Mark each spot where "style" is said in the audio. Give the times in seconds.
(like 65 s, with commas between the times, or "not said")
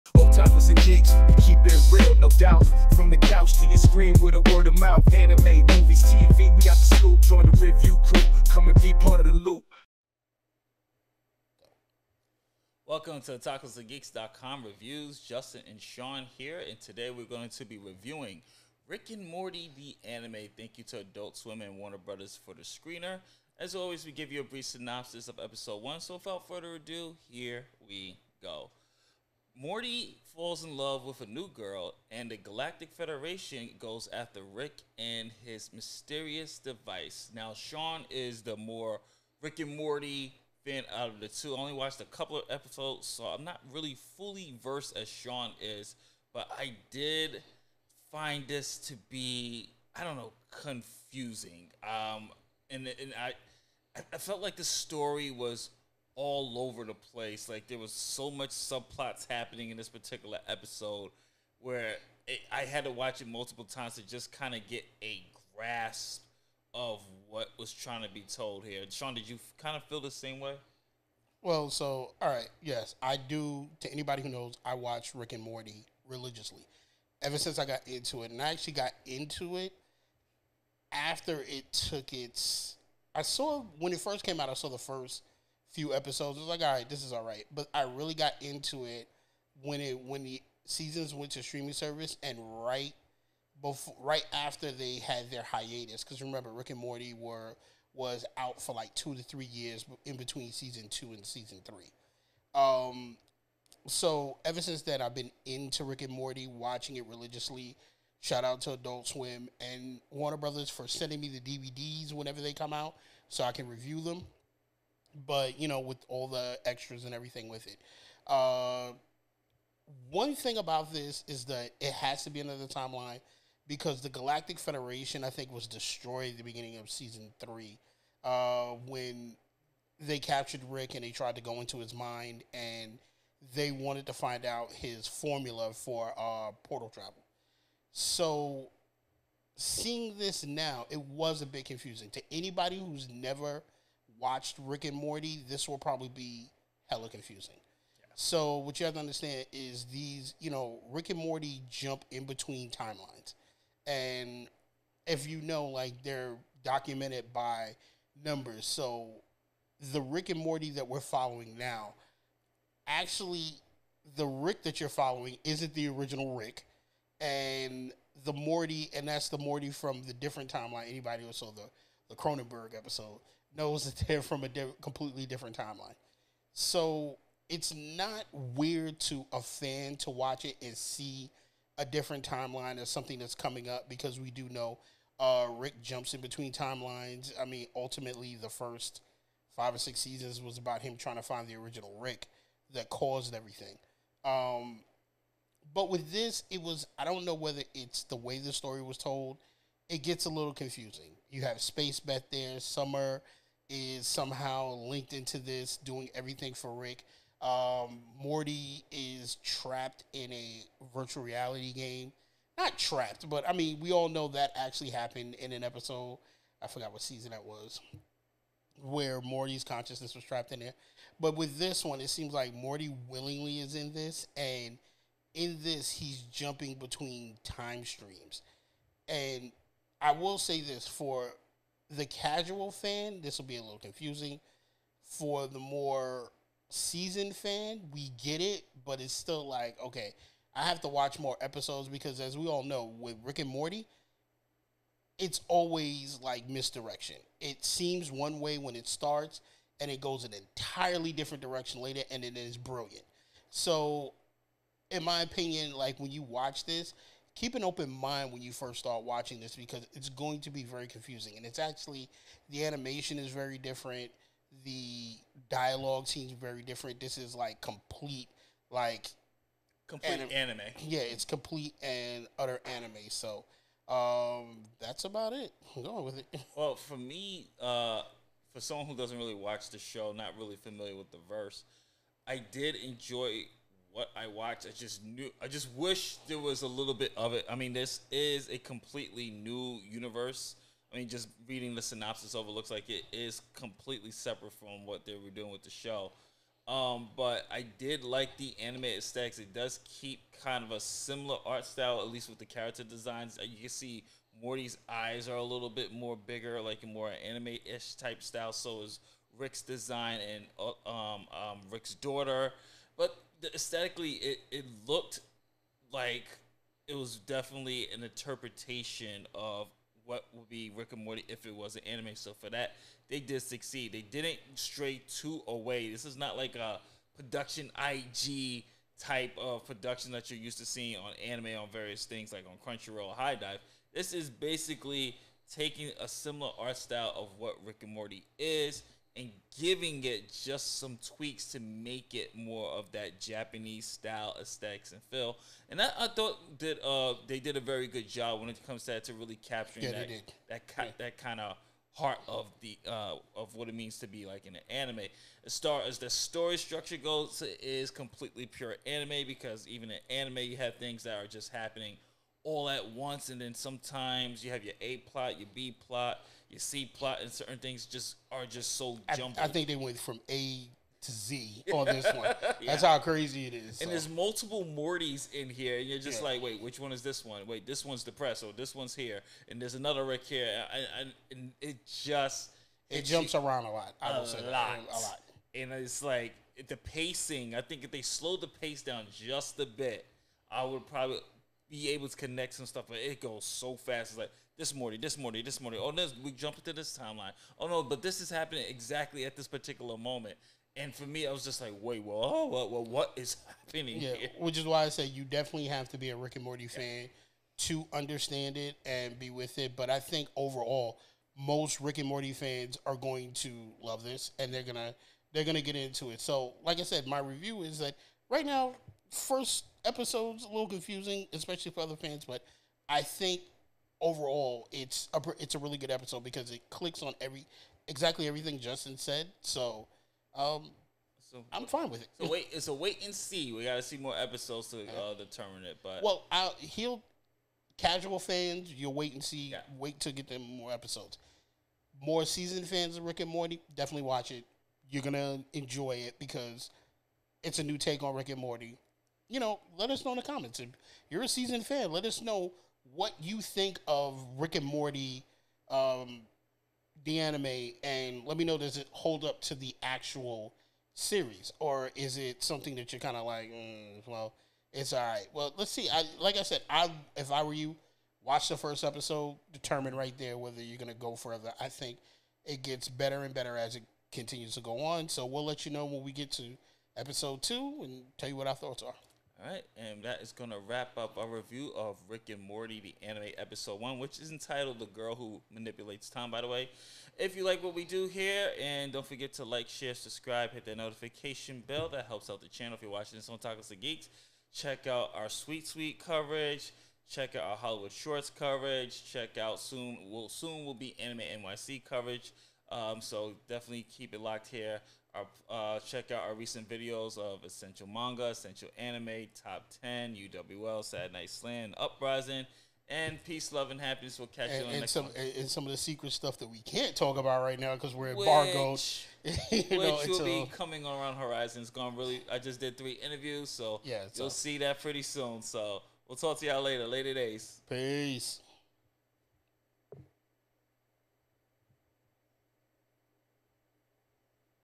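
301 s, 308 s, 336 s, 343 s.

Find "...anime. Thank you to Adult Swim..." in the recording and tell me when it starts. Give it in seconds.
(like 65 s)
20 s.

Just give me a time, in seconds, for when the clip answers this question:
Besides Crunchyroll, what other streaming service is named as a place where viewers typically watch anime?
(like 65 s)
333 s.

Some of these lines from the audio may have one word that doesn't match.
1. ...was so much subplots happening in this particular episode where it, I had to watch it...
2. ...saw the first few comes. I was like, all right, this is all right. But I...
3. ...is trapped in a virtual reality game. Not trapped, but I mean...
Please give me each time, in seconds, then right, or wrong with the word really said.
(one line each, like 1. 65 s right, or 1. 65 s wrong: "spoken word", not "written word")
1. 57 s right
2. 84 s wrong: "episodes", not "comes"
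3. 208 s right.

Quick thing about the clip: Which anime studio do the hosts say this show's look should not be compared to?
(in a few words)
Production IG.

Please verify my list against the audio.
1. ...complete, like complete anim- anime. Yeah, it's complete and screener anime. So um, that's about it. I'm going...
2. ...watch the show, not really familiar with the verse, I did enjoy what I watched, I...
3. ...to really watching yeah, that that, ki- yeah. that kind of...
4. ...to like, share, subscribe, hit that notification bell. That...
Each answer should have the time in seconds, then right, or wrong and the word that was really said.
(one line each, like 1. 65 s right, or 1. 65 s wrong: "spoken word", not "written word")
1. 267 s wrong: "utter", not "screener"
2. 279 s right
3. 349 s wrong: "capturing", not "watching"
4. 489 s right.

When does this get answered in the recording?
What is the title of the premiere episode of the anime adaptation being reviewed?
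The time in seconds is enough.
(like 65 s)
484 s.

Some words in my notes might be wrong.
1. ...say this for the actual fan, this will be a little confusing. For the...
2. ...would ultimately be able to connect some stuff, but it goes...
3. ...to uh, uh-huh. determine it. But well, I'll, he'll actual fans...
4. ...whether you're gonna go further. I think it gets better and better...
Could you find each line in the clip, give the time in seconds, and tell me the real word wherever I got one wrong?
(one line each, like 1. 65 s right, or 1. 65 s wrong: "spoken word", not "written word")
1. 230 s wrong: "casual", not "actual"
2. 390 s wrong: "probably", not "ultimately"
3. 434 s wrong: "casual", not "actual"
4. 470 s right.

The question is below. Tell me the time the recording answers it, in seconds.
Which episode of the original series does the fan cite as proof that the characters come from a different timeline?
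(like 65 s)
172 s.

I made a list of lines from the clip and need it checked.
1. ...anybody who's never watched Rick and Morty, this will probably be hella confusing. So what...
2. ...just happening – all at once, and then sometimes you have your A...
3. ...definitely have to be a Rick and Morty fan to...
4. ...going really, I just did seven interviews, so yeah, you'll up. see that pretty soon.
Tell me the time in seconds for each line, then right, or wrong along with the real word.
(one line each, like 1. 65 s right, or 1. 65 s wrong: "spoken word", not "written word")
1. 142 s right
2. 361 s right
3. 405 s right
4. 521 s wrong: "three", not "seven".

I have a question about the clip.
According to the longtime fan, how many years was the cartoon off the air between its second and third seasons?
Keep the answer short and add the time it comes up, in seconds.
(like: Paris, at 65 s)
2 to 3 years, at 98 s.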